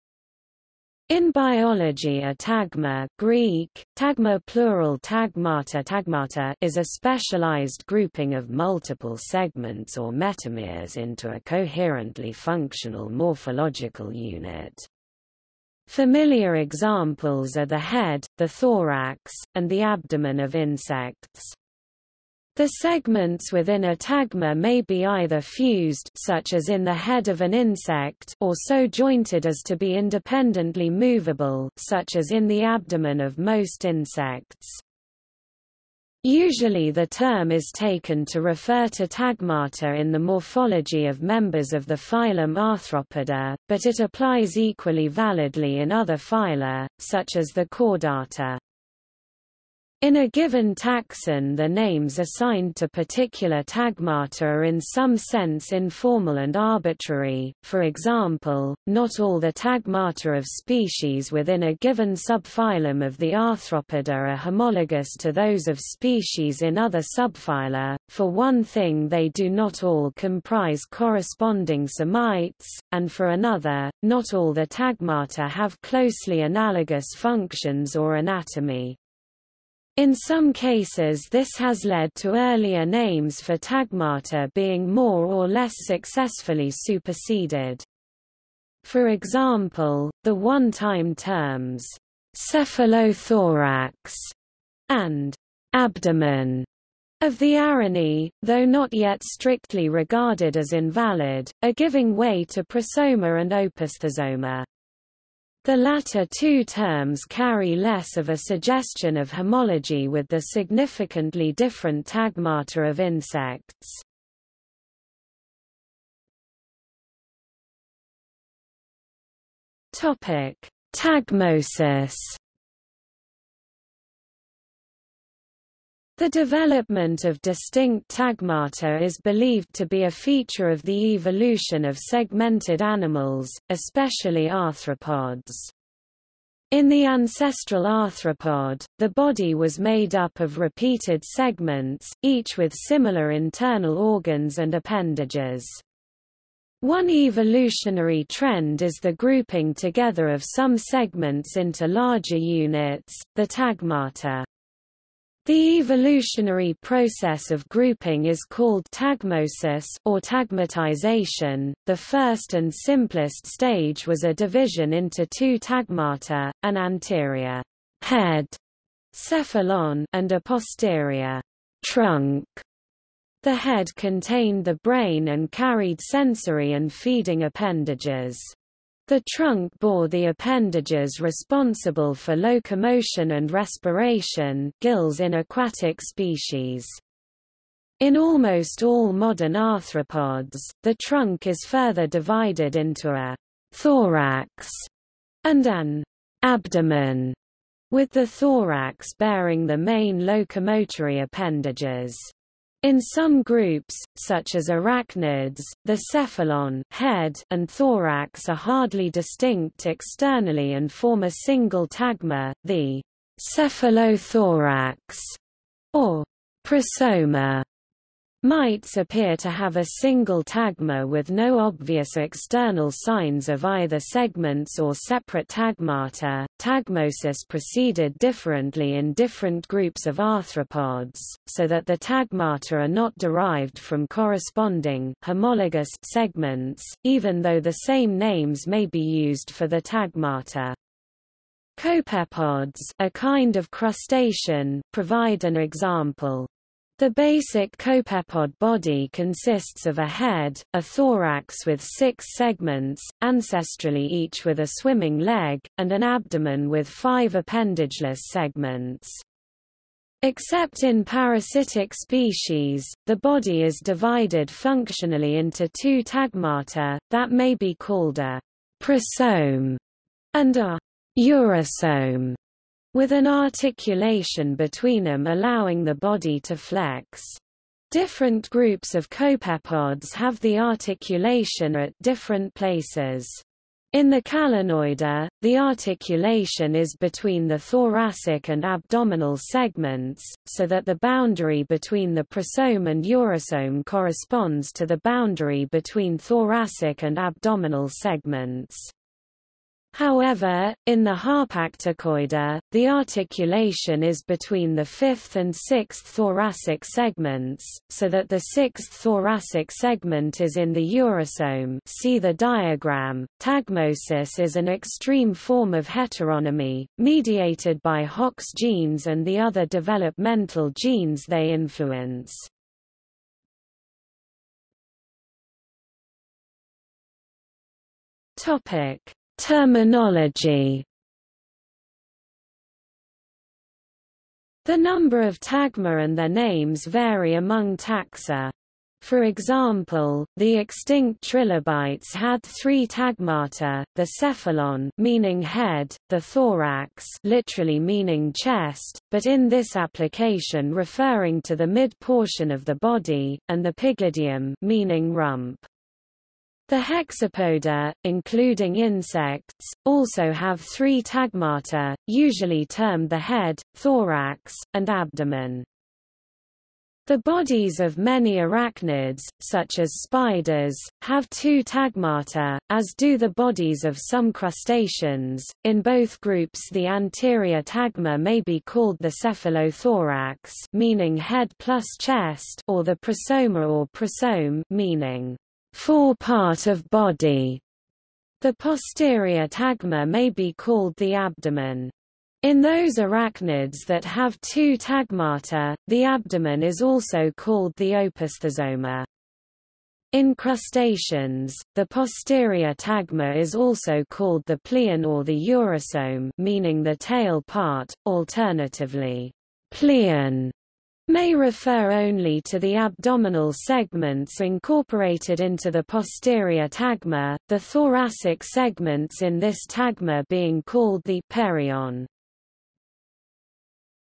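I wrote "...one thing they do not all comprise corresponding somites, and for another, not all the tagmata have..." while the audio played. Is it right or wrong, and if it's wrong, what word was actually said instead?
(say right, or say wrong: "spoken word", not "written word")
right.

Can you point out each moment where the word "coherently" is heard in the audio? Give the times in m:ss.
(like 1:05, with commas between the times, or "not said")
0:11.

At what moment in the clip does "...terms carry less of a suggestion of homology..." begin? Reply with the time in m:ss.
1:46.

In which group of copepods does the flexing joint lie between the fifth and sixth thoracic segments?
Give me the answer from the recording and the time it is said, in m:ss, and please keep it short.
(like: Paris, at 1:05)
Harpacticoida, at 5:01.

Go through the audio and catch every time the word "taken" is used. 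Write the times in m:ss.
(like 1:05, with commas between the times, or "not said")
0:37.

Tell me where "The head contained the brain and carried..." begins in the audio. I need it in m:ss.
2:53.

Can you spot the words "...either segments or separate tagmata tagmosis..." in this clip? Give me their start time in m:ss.
3:43.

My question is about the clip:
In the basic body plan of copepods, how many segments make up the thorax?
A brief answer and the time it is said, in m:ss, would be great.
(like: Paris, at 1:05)
6, at 4:11.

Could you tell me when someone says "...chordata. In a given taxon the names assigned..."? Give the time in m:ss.
0:47.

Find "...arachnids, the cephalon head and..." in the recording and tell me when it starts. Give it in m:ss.
3:24.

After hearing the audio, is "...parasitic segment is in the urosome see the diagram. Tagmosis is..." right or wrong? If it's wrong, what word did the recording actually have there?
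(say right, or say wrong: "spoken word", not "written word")
wrong: "thoracic", not "parasitic".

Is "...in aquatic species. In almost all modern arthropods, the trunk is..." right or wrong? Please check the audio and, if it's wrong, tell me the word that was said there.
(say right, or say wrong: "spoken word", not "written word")
right.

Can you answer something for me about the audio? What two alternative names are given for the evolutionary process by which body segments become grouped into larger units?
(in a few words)
tagmosis or tagmatization.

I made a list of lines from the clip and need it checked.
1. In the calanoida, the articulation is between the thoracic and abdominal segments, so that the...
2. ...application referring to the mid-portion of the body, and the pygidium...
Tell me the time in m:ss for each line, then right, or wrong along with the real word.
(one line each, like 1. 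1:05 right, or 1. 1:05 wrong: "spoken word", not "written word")
1. 4:43 right
2. 5:49 right.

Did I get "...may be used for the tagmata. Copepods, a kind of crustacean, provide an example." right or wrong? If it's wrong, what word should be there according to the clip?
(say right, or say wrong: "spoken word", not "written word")
right.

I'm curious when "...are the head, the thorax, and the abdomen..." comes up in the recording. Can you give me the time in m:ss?
0:17.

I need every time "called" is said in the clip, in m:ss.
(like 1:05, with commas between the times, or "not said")
2:38, 4:27, 6:18, 6:30, 6:37, 6:44, 7:00.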